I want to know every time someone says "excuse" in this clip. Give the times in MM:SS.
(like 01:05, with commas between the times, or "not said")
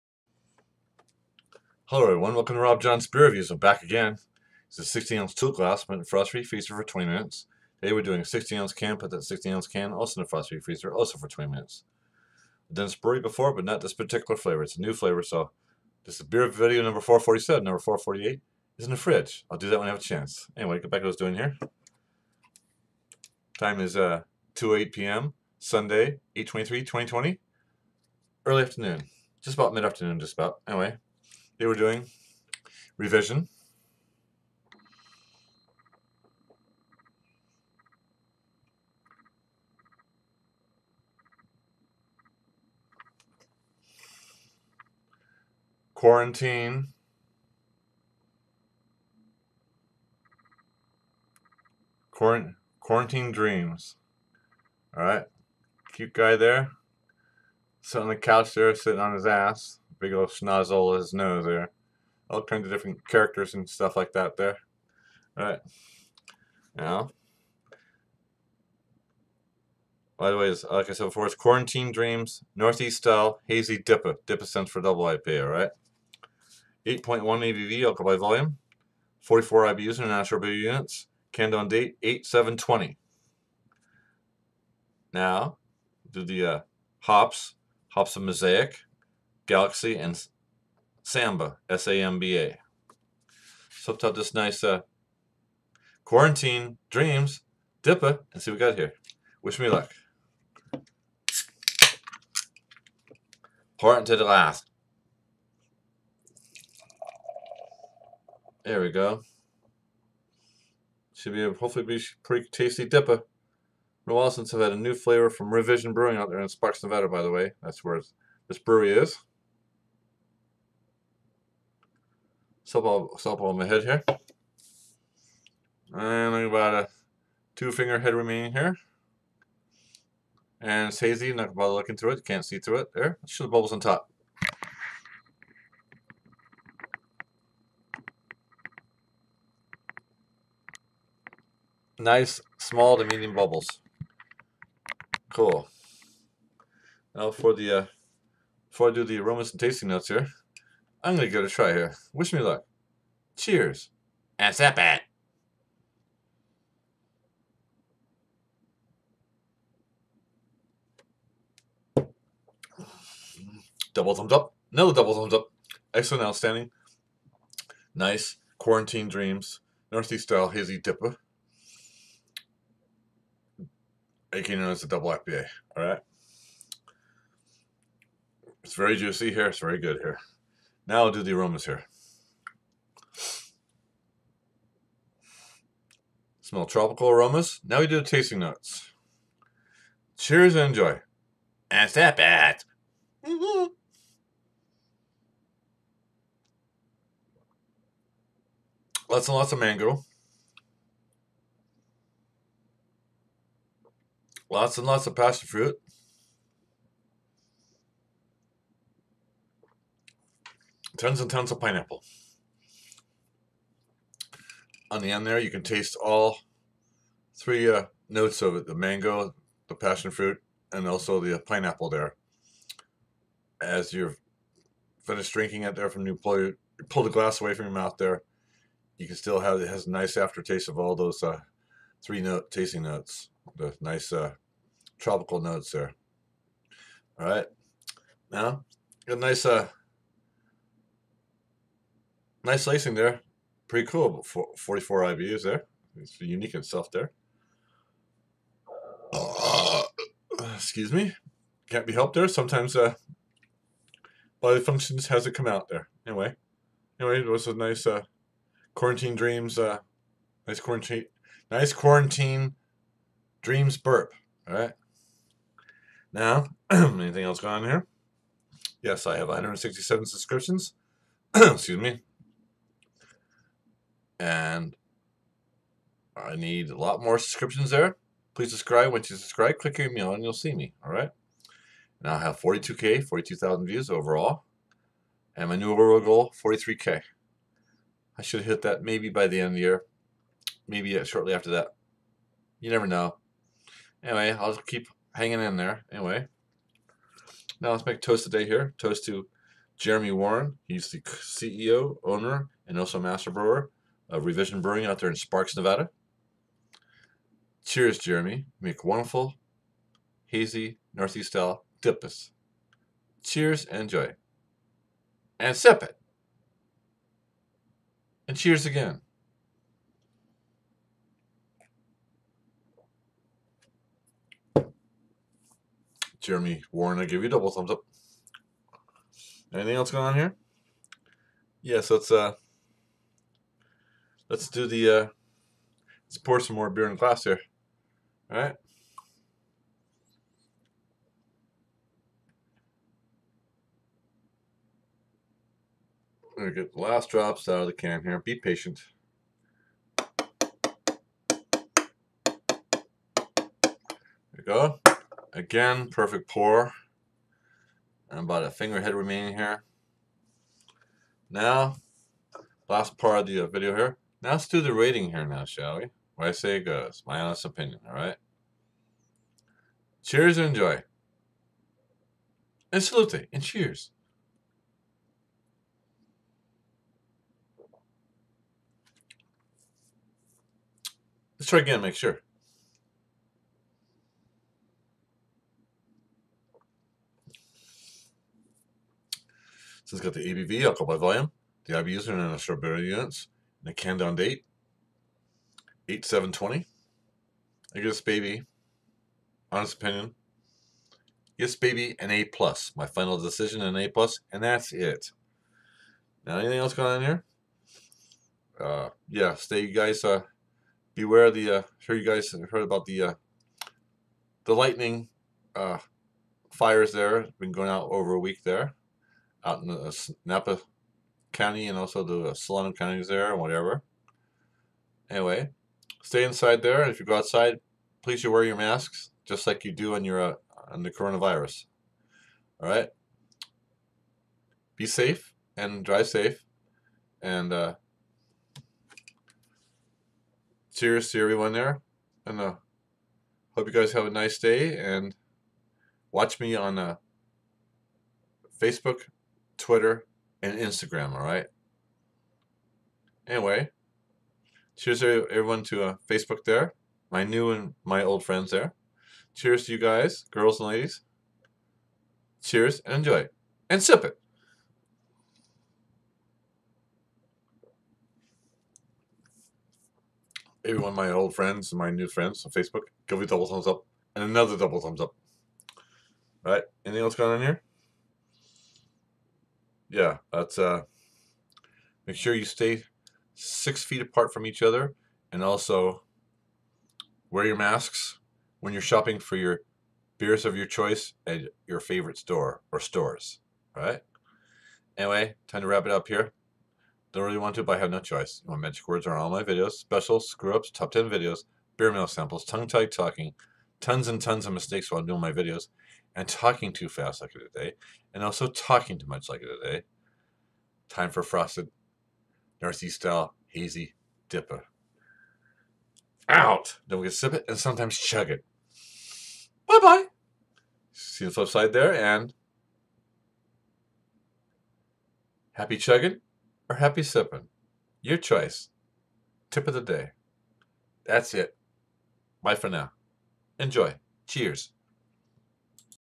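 04:10, 04:31.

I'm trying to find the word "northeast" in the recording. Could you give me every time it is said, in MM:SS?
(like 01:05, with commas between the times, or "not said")
01:12, 02:49, 05:10, 08:32.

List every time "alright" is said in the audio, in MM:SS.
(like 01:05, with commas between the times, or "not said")
01:05, 01:15, 06:07.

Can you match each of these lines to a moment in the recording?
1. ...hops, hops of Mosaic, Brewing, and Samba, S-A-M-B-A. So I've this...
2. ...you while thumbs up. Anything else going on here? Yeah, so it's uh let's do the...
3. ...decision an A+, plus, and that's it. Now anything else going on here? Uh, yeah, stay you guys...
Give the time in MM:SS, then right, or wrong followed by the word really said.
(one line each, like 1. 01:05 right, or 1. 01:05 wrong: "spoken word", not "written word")
1. 01:27 wrong: "Galaxy", not "Brewing"
2. 05:27 wrong: "double", not "while"
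3. 06:43 right.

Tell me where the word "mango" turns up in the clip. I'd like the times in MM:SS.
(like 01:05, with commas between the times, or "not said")
03:19, 03:38.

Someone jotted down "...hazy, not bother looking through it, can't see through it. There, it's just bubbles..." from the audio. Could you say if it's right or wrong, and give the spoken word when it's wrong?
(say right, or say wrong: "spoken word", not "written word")
right.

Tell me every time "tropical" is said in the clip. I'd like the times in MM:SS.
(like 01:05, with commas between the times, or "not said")
03:06, 03:54.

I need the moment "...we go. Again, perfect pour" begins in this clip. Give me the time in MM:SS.
05:54.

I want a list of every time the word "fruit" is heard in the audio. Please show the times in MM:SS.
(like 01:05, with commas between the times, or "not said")
03:25, 03:40.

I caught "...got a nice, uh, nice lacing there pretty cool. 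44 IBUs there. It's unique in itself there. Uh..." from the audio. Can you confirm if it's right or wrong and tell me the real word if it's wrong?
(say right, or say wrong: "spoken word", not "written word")
right.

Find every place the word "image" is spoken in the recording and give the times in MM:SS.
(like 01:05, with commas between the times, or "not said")
not said.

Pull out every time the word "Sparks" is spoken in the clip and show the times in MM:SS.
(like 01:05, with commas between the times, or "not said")
01:56, 05:05.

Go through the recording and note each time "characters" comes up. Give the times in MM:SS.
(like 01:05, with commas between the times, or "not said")
01:03.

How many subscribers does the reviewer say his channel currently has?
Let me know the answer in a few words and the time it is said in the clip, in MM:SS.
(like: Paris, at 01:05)
167, at 04:29.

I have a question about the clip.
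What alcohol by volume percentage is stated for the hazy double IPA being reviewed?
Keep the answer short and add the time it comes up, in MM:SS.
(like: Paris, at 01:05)
8.1, at 01:16.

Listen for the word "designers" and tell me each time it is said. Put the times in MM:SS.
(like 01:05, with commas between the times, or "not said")
not said.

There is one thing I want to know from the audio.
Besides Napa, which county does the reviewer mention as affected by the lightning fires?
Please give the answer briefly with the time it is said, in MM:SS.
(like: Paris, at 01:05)
Solano, at 07:02.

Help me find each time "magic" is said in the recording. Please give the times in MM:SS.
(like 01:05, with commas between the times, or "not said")
08:18.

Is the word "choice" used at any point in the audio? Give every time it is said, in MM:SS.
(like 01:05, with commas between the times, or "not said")
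08:10, 08:17, 08:48.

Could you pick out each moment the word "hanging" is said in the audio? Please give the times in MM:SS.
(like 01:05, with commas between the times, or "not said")
04:55.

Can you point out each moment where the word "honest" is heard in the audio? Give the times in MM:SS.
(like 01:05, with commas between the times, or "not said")
06:07, 06:39.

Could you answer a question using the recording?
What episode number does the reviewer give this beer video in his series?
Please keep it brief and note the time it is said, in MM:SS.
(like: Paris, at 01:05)
447, at 00:17.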